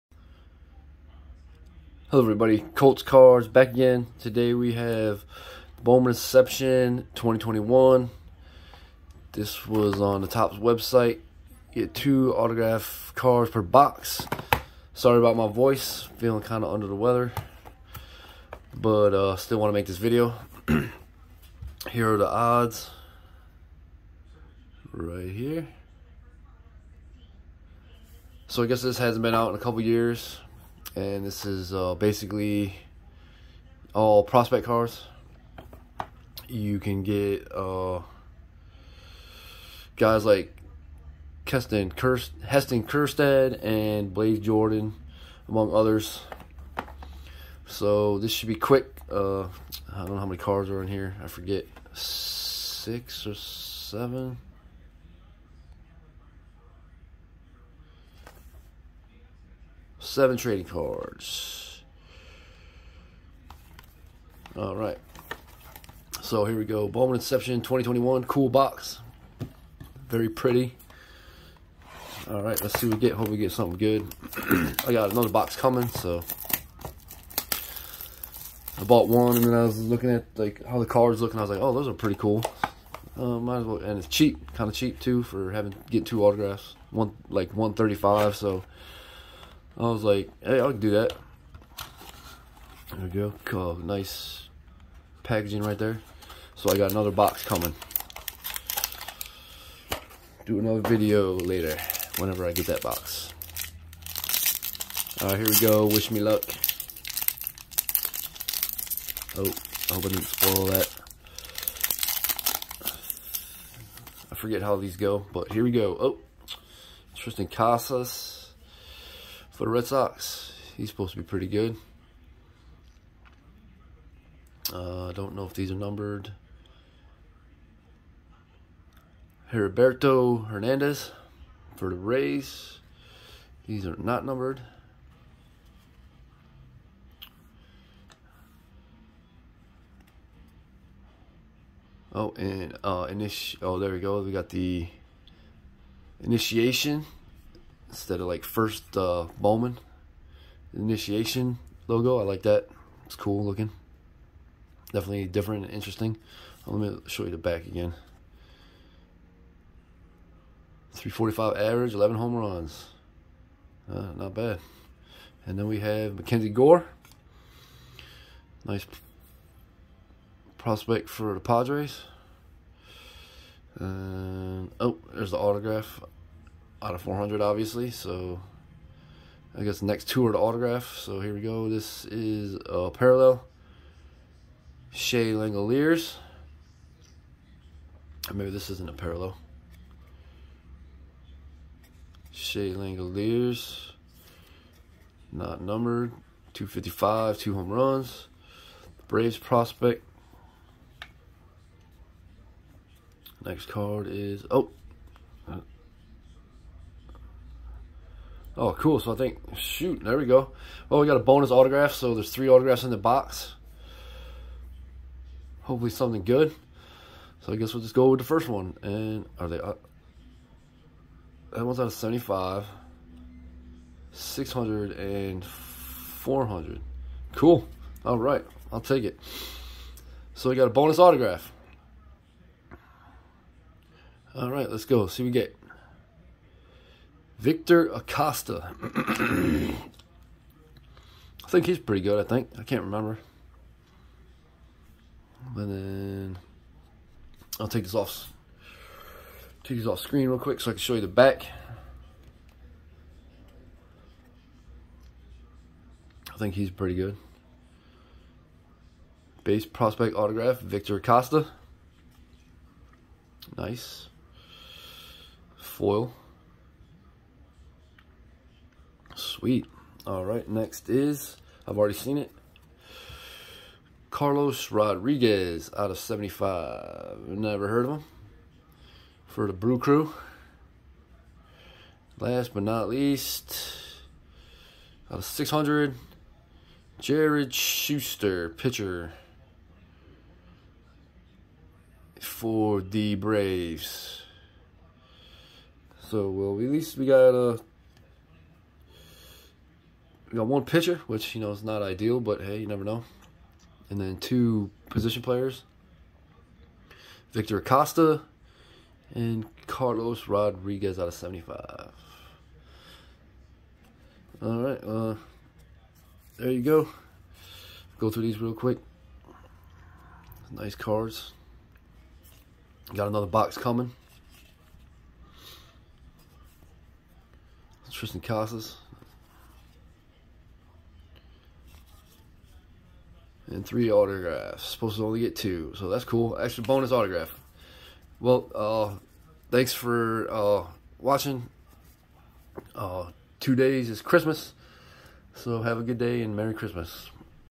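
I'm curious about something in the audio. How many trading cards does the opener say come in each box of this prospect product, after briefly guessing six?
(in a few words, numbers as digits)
7.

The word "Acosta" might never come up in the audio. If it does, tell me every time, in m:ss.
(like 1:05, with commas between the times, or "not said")
3:57, 4:20, 5:07.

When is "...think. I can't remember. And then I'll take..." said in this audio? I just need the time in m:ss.
4:02.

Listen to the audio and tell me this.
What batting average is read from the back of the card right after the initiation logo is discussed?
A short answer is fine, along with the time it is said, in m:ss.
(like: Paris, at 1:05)
345, at 2:40.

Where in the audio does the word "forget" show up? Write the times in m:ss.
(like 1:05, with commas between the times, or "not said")
0:51, 1:54.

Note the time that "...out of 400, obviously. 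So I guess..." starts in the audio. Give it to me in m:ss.
2:56.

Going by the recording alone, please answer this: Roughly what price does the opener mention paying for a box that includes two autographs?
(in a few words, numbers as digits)
135.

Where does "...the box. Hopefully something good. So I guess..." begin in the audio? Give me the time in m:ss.
3:32.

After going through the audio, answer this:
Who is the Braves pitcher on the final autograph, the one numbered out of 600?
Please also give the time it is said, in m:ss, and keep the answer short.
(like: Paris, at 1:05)
Jared Shuster, at 4:46.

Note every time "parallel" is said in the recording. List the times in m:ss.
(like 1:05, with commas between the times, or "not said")
3:02, 3:08.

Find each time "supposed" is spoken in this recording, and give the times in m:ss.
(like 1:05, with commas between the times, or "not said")
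2:00, 5:34.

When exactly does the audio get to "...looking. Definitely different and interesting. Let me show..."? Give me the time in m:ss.
2:33.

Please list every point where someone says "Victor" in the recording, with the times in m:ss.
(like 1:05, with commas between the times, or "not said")
3:57, 4:20, 5:07.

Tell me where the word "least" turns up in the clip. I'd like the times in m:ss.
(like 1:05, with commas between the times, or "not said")
4:42, 4:56.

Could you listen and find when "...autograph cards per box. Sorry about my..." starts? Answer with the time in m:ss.
0:12.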